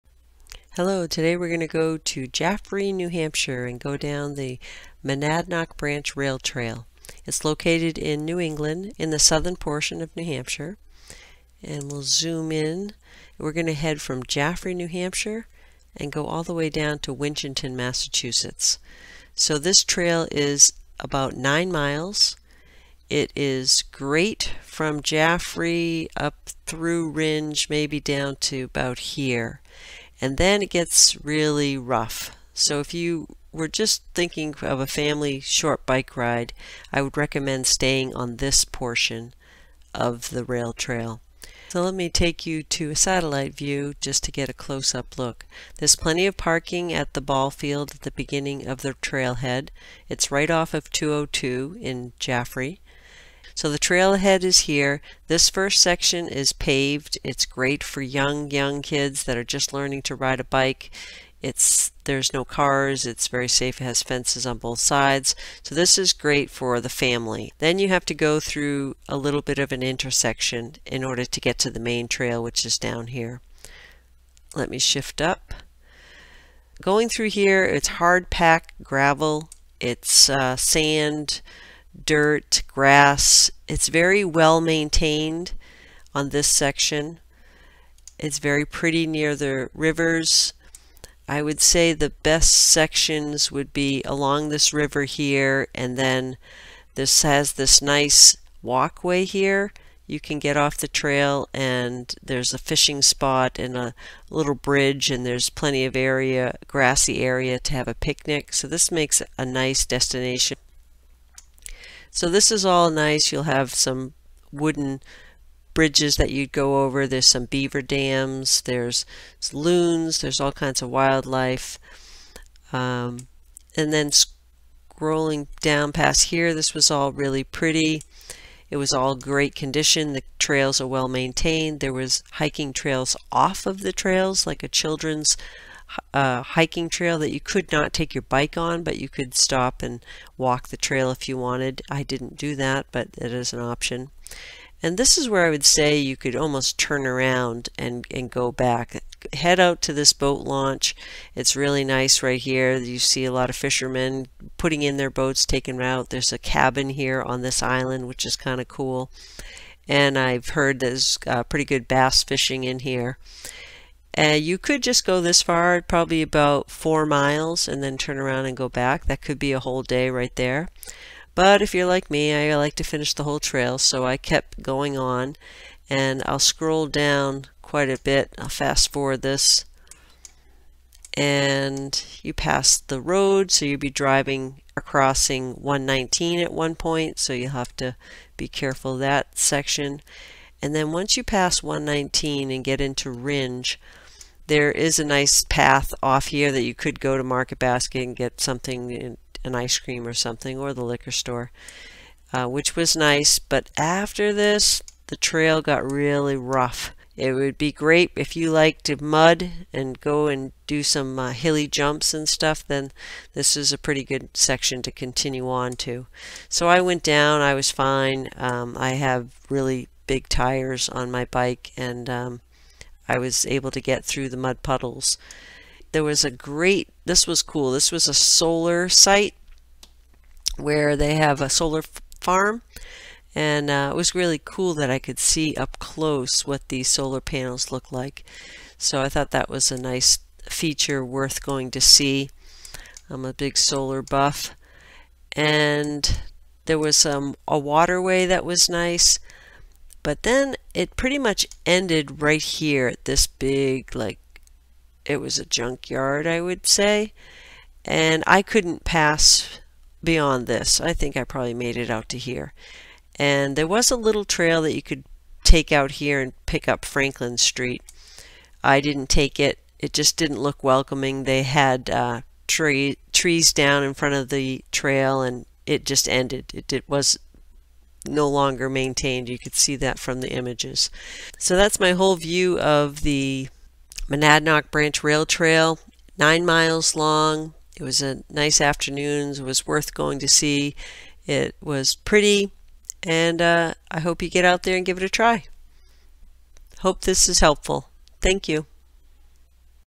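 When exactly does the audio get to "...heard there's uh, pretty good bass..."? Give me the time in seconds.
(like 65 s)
160 s.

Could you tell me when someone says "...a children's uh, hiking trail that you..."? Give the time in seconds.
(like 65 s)
134 s.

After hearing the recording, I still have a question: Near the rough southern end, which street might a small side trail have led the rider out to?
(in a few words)
Franklin Street.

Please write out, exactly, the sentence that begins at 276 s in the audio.
It, it was no longer maintained.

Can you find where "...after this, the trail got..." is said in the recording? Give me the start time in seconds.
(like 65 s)
203 s.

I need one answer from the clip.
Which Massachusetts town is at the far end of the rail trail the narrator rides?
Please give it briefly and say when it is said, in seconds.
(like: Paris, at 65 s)
Winchendon, at 17 s.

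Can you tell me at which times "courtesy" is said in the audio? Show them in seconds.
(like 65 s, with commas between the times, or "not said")
not said.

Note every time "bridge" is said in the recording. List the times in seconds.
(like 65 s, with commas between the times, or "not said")
104 s, 115 s.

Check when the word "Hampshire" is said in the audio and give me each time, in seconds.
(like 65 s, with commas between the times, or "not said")
3 s, 10 s, 14 s.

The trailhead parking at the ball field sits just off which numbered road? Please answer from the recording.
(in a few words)
202.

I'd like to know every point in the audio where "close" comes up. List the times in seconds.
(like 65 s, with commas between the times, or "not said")
44 s, 235 s.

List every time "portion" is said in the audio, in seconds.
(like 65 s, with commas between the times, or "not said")
9 s, 38 s.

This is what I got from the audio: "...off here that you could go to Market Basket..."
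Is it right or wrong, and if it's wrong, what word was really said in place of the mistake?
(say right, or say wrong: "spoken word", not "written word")
right.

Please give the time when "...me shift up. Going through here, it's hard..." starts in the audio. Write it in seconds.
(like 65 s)
74 s.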